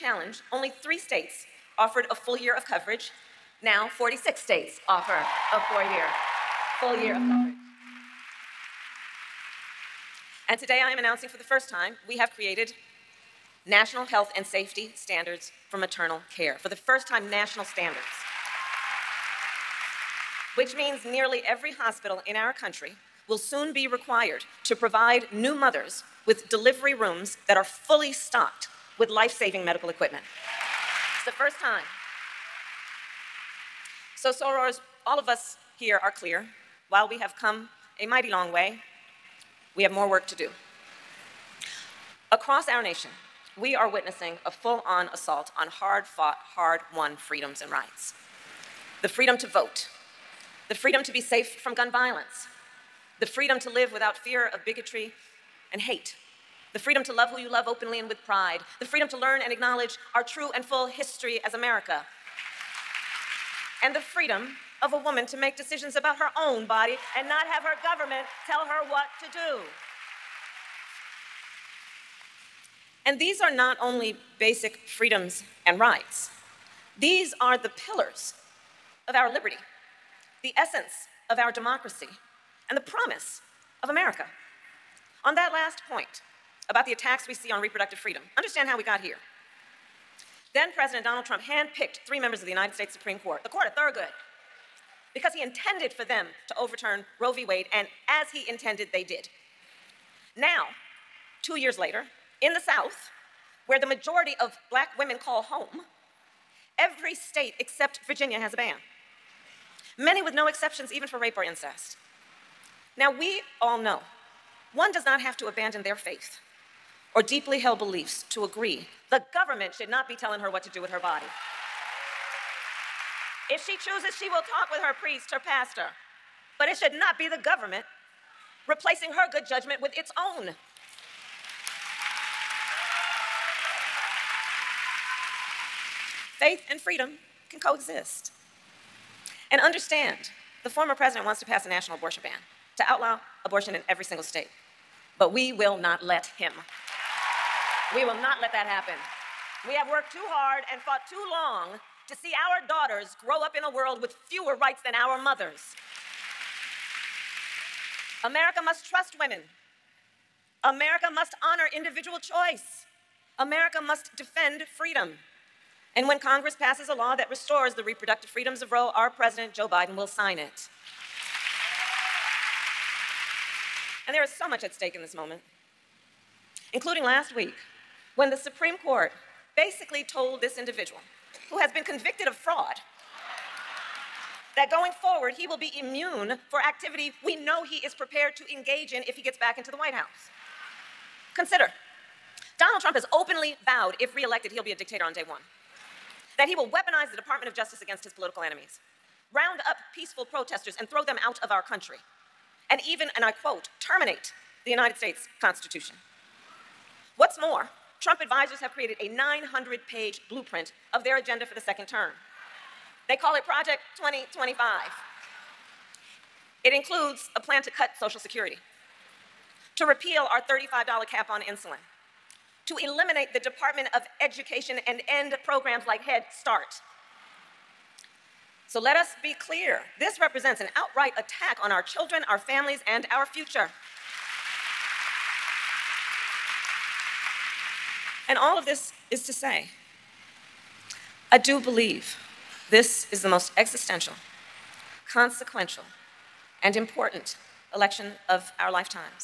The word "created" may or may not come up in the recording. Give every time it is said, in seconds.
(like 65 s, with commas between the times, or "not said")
12 s, 208 s.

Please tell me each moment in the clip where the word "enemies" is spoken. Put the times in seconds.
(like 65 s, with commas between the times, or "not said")
198 s.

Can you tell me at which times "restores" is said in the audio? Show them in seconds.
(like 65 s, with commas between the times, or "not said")
167 s.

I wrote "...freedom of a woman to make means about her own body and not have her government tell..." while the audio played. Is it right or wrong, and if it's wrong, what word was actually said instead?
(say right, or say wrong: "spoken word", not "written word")
wrong: "decisions", not "means".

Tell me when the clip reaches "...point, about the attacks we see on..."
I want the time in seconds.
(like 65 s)
85 s.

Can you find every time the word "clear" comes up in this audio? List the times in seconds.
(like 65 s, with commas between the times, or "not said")
36 s, 229 s.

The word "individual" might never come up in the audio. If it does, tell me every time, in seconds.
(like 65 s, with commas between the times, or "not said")
161 s, 180 s.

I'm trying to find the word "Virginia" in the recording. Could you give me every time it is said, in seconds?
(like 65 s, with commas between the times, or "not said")
108 s.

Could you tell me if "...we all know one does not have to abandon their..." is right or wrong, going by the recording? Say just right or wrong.
right.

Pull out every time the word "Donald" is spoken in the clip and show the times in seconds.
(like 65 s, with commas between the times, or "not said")
91 s, 192 s.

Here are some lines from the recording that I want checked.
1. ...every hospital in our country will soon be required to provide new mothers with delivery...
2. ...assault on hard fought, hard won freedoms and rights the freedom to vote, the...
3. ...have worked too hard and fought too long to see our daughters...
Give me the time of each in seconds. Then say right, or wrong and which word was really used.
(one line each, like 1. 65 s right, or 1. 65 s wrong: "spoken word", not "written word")
1. 21 s right
2. 45 s right
3. 149 s right.